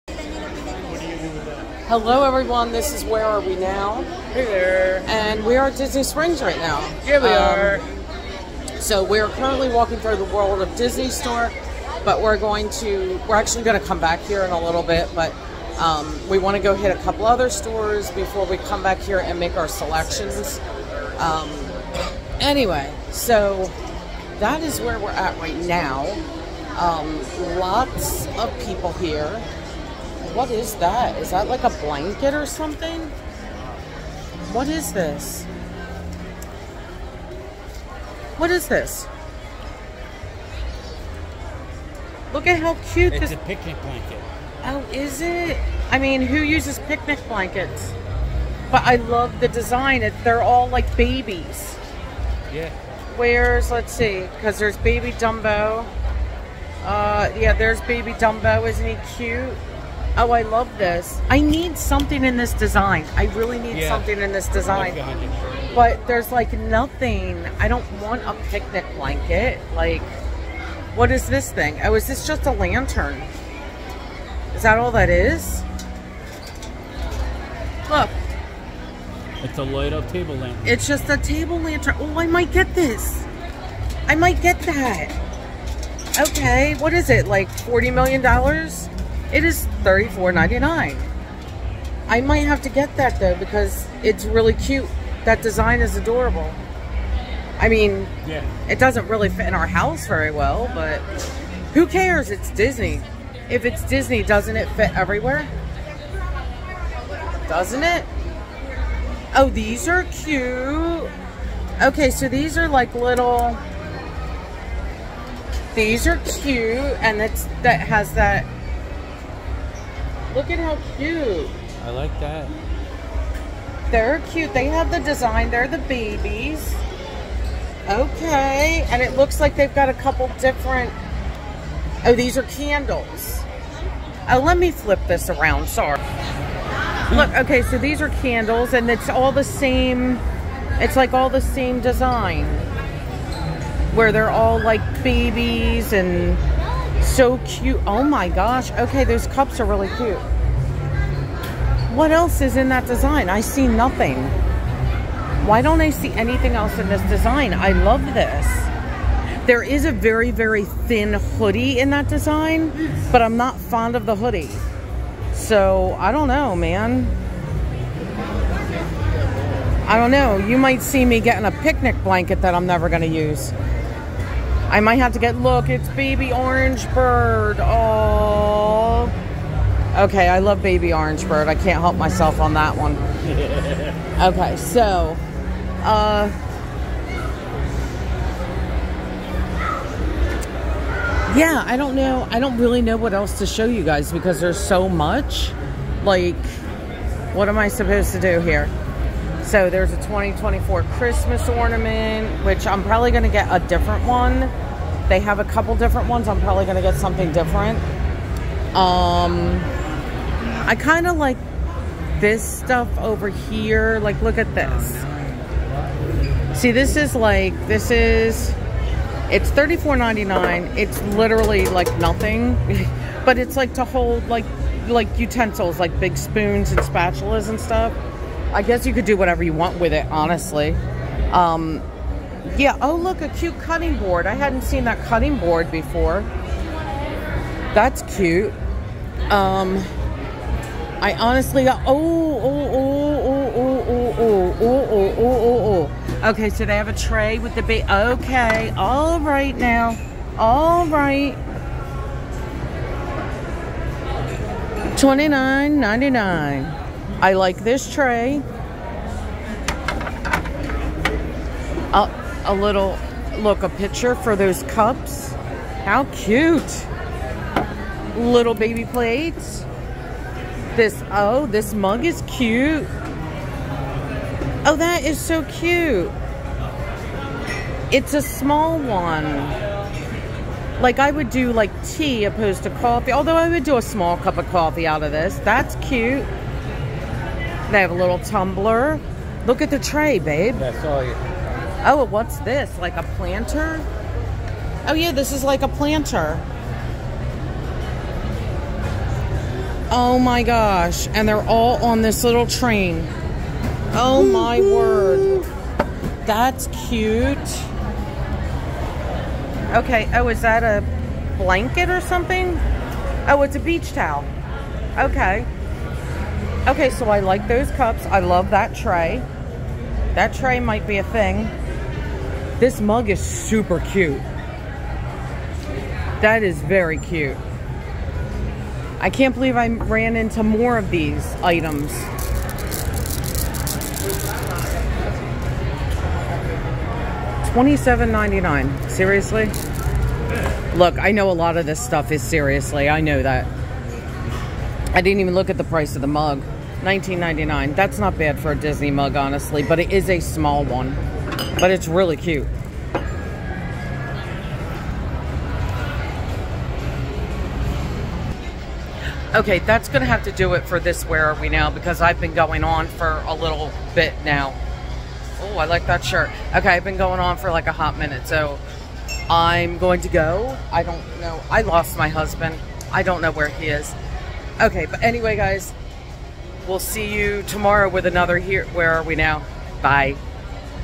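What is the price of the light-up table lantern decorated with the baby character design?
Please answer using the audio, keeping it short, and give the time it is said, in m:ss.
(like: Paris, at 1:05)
$34.99, at 1:29.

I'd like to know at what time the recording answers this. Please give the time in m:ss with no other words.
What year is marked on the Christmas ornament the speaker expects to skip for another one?
3:19.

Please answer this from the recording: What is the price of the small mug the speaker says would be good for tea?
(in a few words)
$19.99.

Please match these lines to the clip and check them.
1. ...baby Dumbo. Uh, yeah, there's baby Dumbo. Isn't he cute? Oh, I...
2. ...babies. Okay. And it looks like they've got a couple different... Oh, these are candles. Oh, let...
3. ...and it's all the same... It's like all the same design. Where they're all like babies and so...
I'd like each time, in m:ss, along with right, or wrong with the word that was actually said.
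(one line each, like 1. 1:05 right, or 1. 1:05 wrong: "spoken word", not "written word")
1. 0:54 right
2. 2:05 right
3. 2:18 right.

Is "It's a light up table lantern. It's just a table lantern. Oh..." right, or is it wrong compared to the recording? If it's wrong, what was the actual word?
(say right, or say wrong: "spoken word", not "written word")
right.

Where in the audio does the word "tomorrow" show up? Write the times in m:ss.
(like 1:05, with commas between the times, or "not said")
6:17.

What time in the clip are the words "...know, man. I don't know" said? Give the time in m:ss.
2:46.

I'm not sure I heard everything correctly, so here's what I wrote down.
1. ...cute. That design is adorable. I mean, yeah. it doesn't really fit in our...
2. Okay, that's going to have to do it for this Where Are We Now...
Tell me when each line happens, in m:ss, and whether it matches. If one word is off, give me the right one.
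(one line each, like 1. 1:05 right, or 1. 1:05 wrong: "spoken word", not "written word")
1. 1:34 right
2. 5:59 right.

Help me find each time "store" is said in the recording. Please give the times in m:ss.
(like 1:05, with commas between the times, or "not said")
0:11, 0:17.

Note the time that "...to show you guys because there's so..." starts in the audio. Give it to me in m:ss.
3:13.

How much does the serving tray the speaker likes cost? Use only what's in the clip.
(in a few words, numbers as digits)
$29.99.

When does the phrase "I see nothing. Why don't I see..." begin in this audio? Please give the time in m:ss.
2:33.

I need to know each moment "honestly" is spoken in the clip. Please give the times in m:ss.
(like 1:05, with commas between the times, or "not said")
3:50, 4:01, 5:49.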